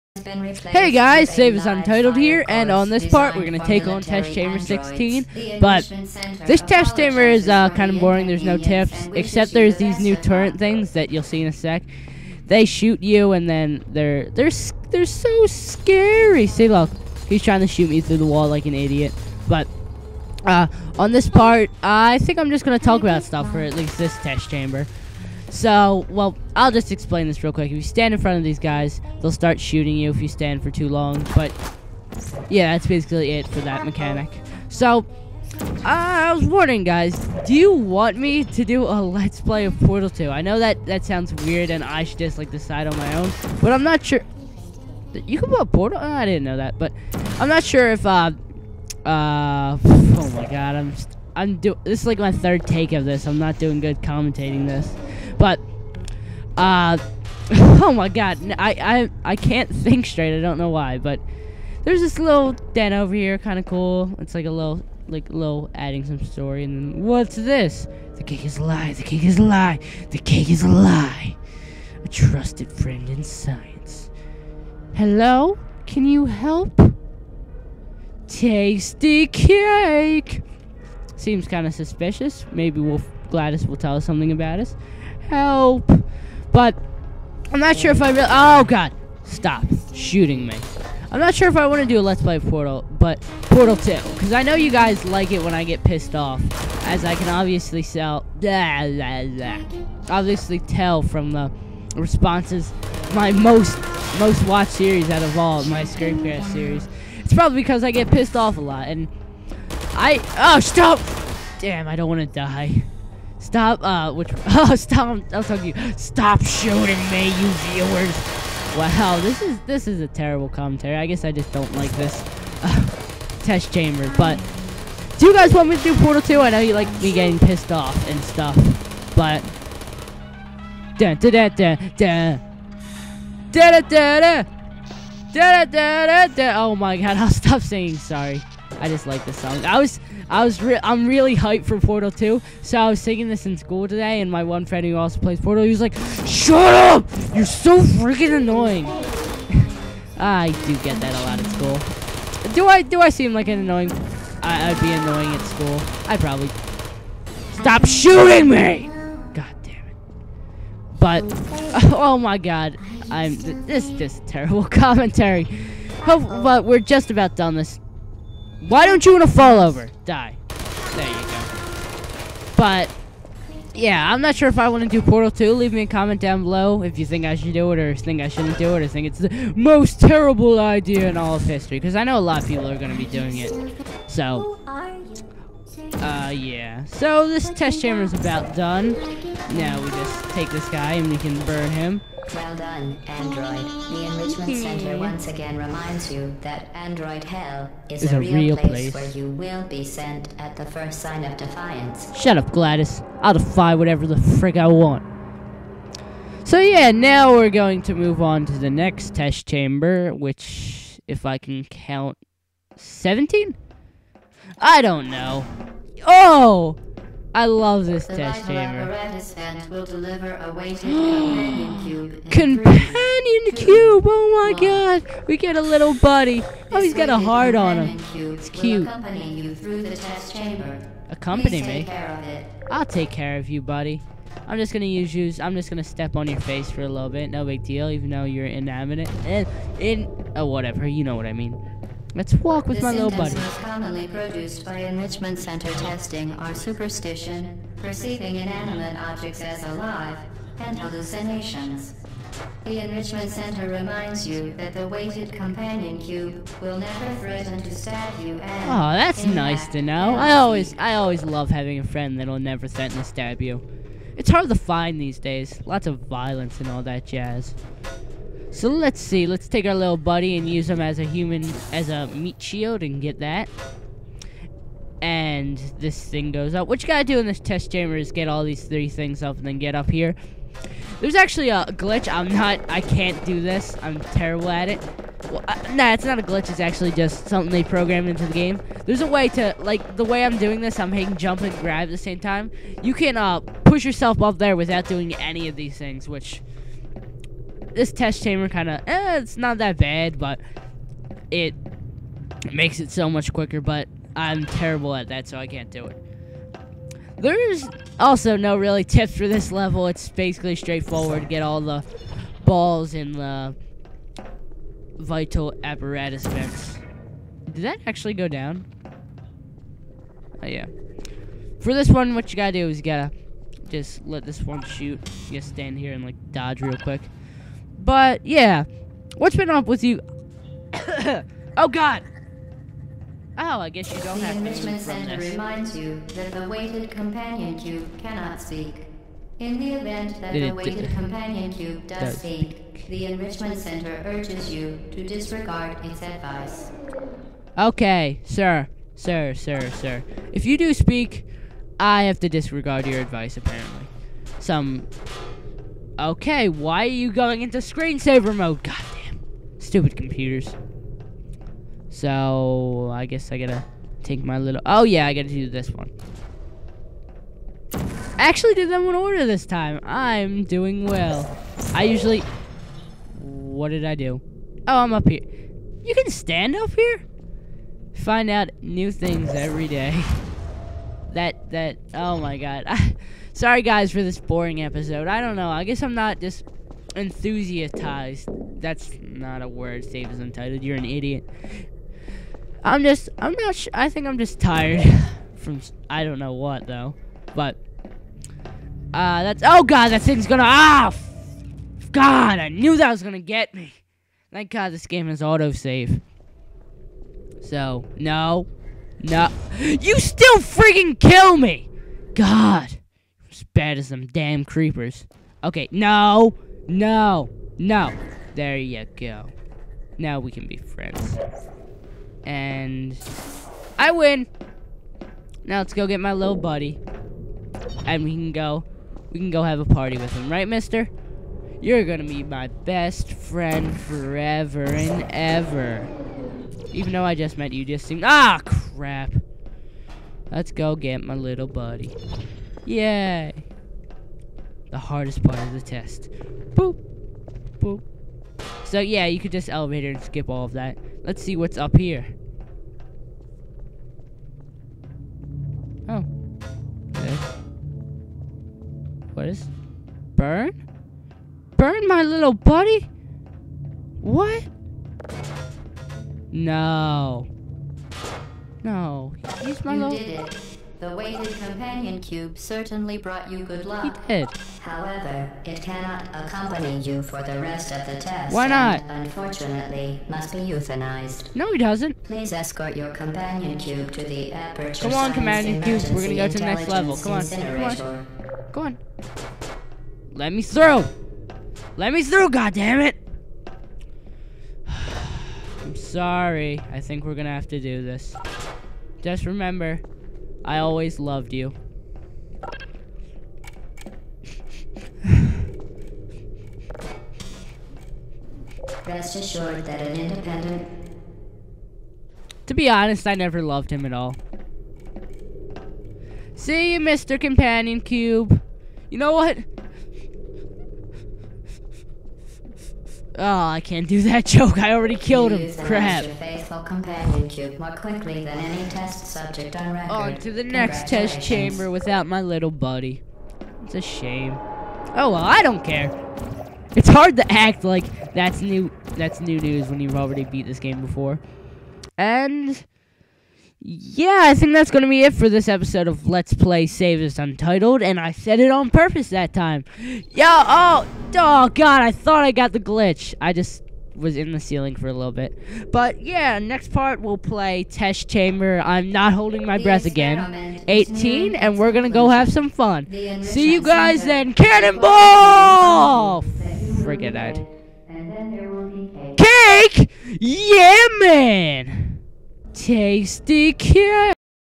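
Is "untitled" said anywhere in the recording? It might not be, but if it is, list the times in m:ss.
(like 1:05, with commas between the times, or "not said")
0:01, 6:30, 9:07.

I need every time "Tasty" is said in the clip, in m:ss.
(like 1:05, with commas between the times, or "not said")
1:18, 9:32.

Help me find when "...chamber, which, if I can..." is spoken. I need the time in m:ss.
3:29.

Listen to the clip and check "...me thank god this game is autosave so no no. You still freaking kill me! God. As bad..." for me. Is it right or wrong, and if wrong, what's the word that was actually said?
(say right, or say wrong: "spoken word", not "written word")
right.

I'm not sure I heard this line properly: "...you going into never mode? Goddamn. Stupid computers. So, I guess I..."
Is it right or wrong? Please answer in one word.
wrong.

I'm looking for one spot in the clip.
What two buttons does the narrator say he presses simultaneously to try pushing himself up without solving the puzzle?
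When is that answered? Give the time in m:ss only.
4:51.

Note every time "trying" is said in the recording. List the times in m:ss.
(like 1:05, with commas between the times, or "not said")
0:17.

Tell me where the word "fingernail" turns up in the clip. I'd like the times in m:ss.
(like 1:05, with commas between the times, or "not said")
not said.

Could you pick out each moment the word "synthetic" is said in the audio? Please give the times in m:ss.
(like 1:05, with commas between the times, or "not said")
not said.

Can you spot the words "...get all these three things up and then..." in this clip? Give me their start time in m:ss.
4:38.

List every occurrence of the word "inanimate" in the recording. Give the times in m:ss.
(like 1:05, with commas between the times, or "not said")
3:58, 4:08.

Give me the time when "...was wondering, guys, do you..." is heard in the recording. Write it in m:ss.
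0:36.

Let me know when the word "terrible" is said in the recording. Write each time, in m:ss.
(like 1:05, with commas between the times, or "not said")
2:00, 2:44, 2:59, 4:43, 5:04.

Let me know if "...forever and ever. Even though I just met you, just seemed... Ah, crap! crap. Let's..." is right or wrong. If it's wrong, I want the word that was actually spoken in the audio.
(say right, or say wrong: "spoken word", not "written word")
right.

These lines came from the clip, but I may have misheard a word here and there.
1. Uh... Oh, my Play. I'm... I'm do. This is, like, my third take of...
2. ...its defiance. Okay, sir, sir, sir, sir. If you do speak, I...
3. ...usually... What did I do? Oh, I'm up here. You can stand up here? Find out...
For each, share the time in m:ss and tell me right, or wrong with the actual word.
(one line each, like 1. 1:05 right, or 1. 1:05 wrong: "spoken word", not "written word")
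1. 0:49 wrong: "God", not "Play"
2. 5:45 wrong: "advice", not "defiance"
3. 6:11 right.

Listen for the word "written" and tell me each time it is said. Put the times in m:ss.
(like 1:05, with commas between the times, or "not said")
not said.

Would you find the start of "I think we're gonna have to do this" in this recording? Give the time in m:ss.
8:16.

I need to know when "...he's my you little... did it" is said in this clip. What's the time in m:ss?
7:49.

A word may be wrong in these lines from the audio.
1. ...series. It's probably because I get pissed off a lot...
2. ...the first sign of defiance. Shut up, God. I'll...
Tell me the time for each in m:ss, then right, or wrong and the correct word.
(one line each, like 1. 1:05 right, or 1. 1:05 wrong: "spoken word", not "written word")
1. 1:46 right
2. 3:20 wrong: "GLaDOS", not "God".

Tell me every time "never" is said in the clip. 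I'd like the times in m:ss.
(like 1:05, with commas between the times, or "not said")
4:16, 4:22, 8:33.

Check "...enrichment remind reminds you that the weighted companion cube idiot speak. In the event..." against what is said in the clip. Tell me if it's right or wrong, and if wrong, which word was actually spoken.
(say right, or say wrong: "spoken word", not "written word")
wrong: "cannot", not "idiot".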